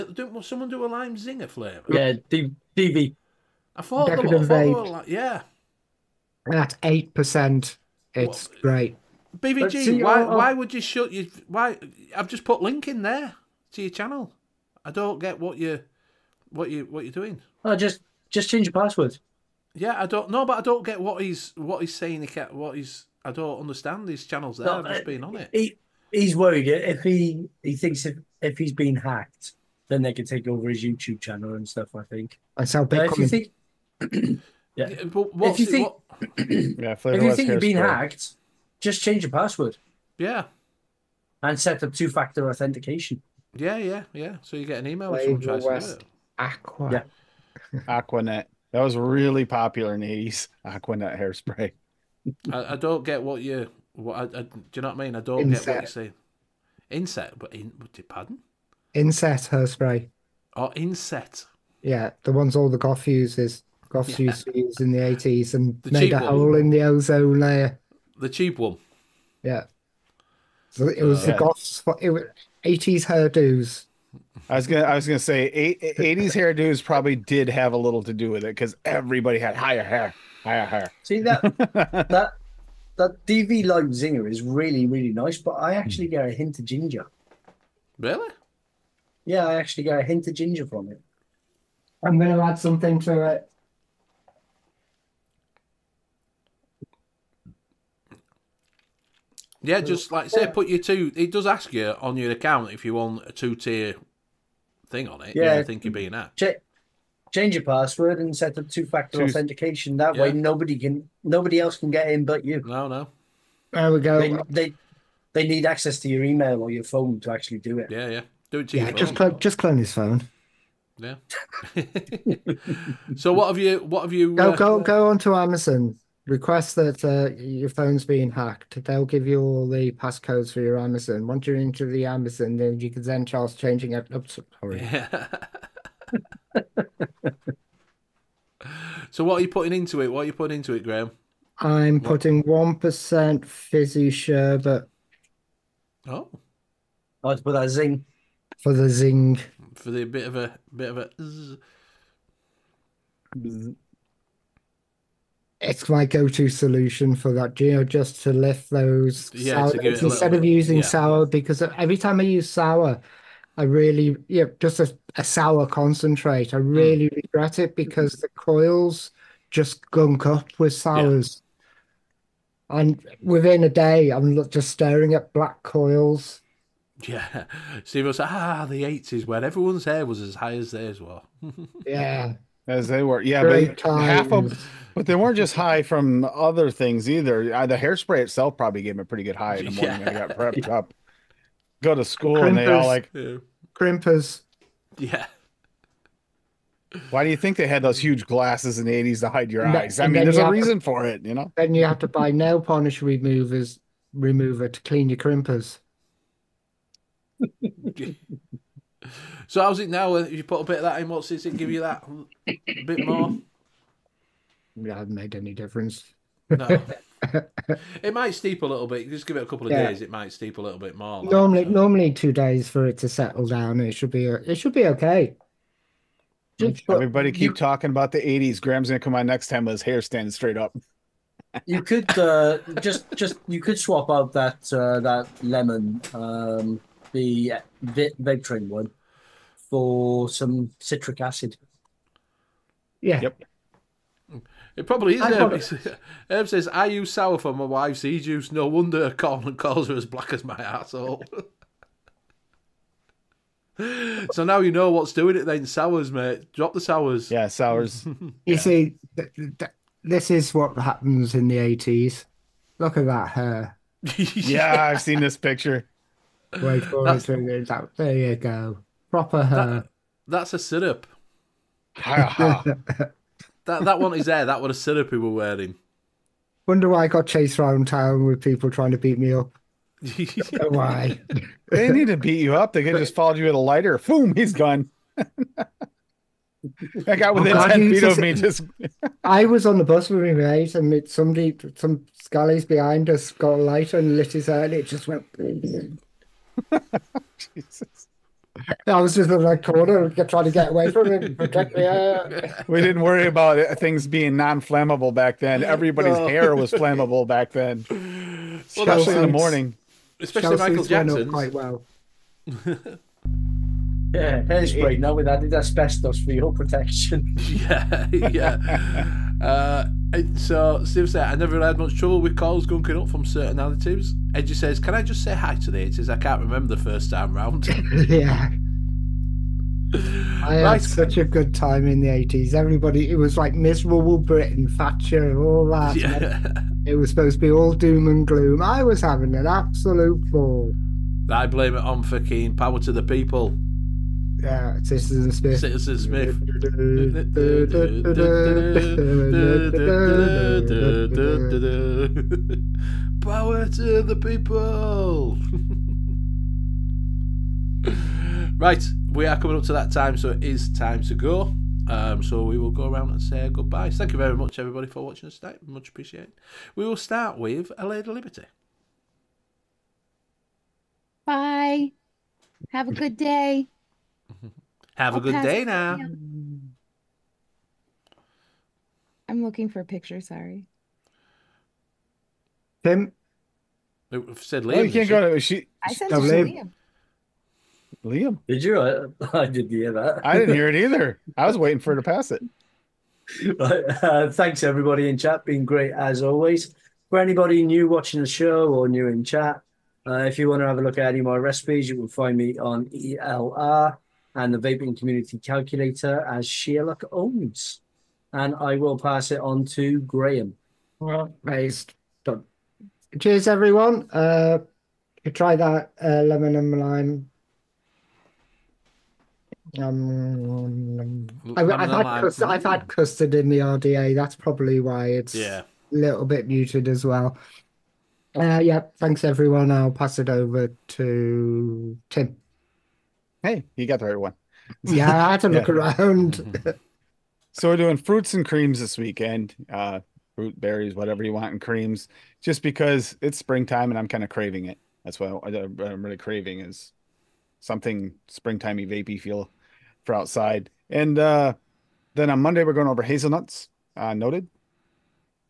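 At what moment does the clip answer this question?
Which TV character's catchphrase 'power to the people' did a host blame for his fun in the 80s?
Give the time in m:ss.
5:44.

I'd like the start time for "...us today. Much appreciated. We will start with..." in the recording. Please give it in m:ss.
6:05.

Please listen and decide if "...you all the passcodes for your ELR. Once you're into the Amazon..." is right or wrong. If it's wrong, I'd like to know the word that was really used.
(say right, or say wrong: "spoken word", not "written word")
wrong: "Amazon", not "ELR".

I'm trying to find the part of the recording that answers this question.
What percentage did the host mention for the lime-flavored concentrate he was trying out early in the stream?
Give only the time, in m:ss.
0:06.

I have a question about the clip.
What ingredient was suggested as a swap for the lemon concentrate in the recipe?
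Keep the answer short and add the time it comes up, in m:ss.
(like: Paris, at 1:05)
Citric acid, at 4:00.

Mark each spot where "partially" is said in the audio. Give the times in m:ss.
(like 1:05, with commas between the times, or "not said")
not said.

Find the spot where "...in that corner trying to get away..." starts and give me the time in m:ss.
4:59.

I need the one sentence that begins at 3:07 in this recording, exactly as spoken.
the hairspray itself probably gave me a pretty good high in the morning.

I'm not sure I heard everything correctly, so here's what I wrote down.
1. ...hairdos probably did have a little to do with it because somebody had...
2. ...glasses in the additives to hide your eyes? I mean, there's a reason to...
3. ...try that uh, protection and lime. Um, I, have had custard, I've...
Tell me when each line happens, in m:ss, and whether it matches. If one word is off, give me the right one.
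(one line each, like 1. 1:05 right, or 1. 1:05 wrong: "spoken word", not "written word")
1. 1:16 wrong: "everybody", not "somebody"
2. 3:18 wrong: "eighties", not "additives"
3. 6:55 wrong: "lemon", not "protection".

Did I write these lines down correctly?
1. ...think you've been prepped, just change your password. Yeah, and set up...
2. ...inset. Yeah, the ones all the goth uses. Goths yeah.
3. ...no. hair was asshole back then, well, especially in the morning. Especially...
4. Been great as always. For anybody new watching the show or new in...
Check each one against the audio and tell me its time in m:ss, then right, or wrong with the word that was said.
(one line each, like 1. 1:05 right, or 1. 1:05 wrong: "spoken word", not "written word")
1. 0:37 wrong: "hacked", not "prepped"
2. 1:00 right
3. 5:06 wrong: "flammable", not "asshole"
4. 6:35 right.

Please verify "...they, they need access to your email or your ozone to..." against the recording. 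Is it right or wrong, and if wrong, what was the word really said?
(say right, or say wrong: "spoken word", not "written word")
wrong: "phone", not "ozone".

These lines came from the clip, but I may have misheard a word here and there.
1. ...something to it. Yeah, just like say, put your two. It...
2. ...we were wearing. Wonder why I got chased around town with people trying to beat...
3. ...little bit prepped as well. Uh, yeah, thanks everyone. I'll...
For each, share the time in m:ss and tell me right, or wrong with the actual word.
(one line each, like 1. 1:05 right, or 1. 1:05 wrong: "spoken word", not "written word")
1. 1:32 right
2. 4:35 right
3. 7:05 wrong: "muted", not "prepped".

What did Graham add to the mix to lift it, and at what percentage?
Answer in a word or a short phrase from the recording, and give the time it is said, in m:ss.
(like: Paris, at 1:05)
1 percent fizzy sherbet, at 2:22.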